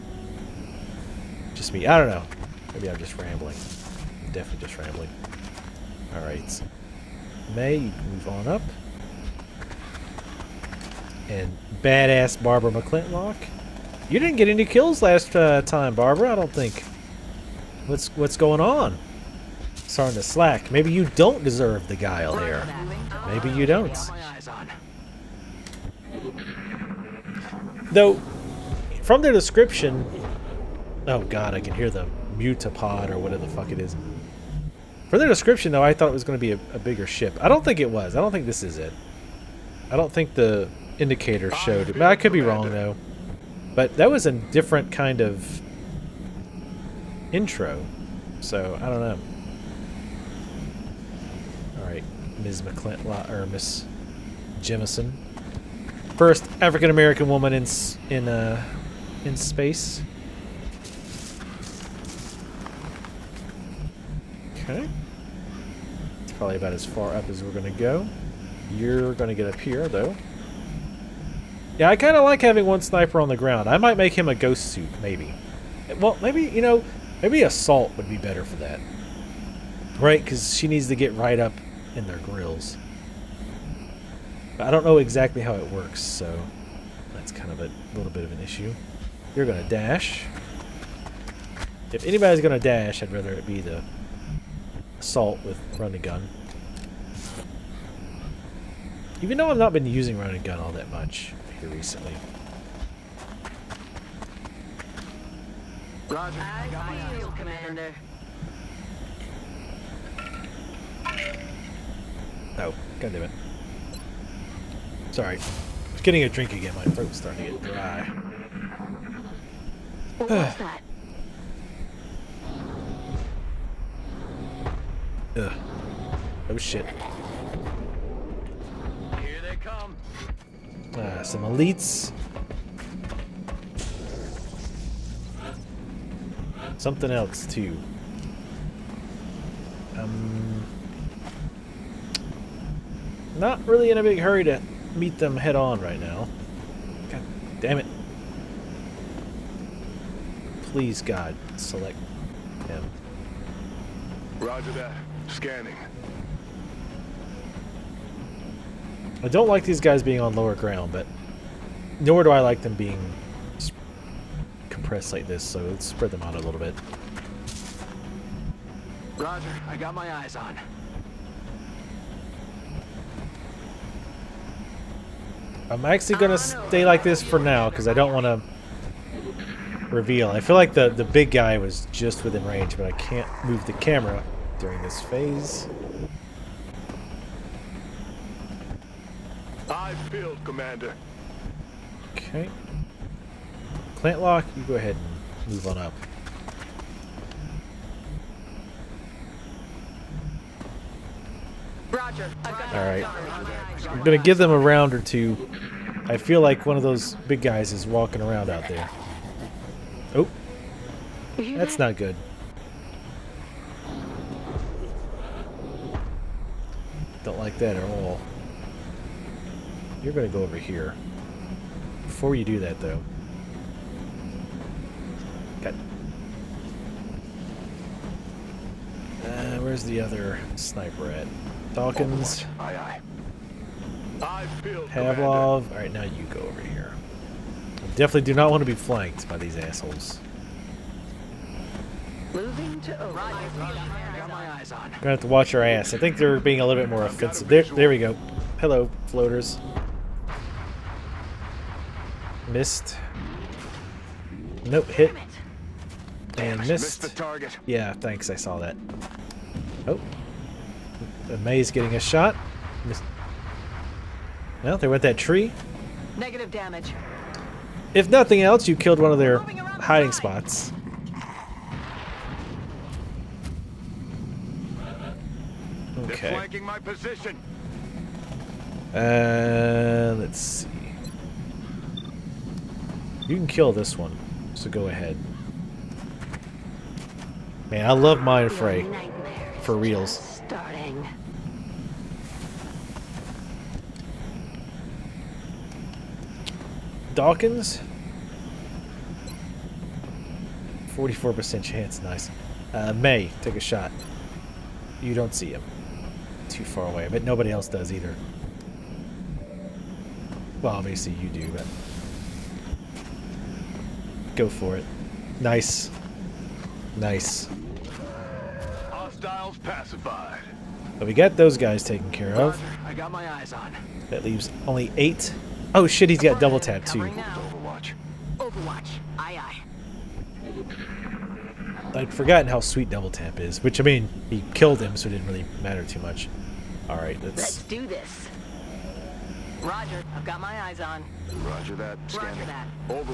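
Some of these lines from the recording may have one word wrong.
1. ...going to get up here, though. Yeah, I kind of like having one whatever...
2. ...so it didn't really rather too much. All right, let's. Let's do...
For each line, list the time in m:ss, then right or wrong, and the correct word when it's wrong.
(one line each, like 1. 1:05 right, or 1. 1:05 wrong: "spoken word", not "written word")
1. 1:09 wrong: "sniper", not "whatever"
2. 5:34 wrong: "matter", not "rather".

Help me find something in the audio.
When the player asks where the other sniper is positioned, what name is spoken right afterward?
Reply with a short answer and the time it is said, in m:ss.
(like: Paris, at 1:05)
Falcons, at 3:51.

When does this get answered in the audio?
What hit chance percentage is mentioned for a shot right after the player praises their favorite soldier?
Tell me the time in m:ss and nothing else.
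5:00.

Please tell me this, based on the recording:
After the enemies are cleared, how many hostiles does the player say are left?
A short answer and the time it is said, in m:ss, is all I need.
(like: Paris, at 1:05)
8, at 5:24.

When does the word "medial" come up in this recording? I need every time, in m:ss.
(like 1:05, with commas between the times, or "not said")
not said.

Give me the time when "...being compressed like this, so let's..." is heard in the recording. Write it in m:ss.
2:42.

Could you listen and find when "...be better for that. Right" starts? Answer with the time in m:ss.
1:18.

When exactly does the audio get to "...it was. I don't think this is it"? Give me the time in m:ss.
0:37.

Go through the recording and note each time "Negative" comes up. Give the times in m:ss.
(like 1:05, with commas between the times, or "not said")
4:26.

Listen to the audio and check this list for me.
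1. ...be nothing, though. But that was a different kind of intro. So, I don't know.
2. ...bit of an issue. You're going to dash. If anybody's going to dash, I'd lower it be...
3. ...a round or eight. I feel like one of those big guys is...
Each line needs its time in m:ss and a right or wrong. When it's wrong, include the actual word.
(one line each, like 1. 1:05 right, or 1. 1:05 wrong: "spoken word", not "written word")
1. 0:42 wrong: "wrong", not "nothing"
2. 1:28 wrong: "rather", not "lower"
3. 3:24 wrong: "two", not "eight".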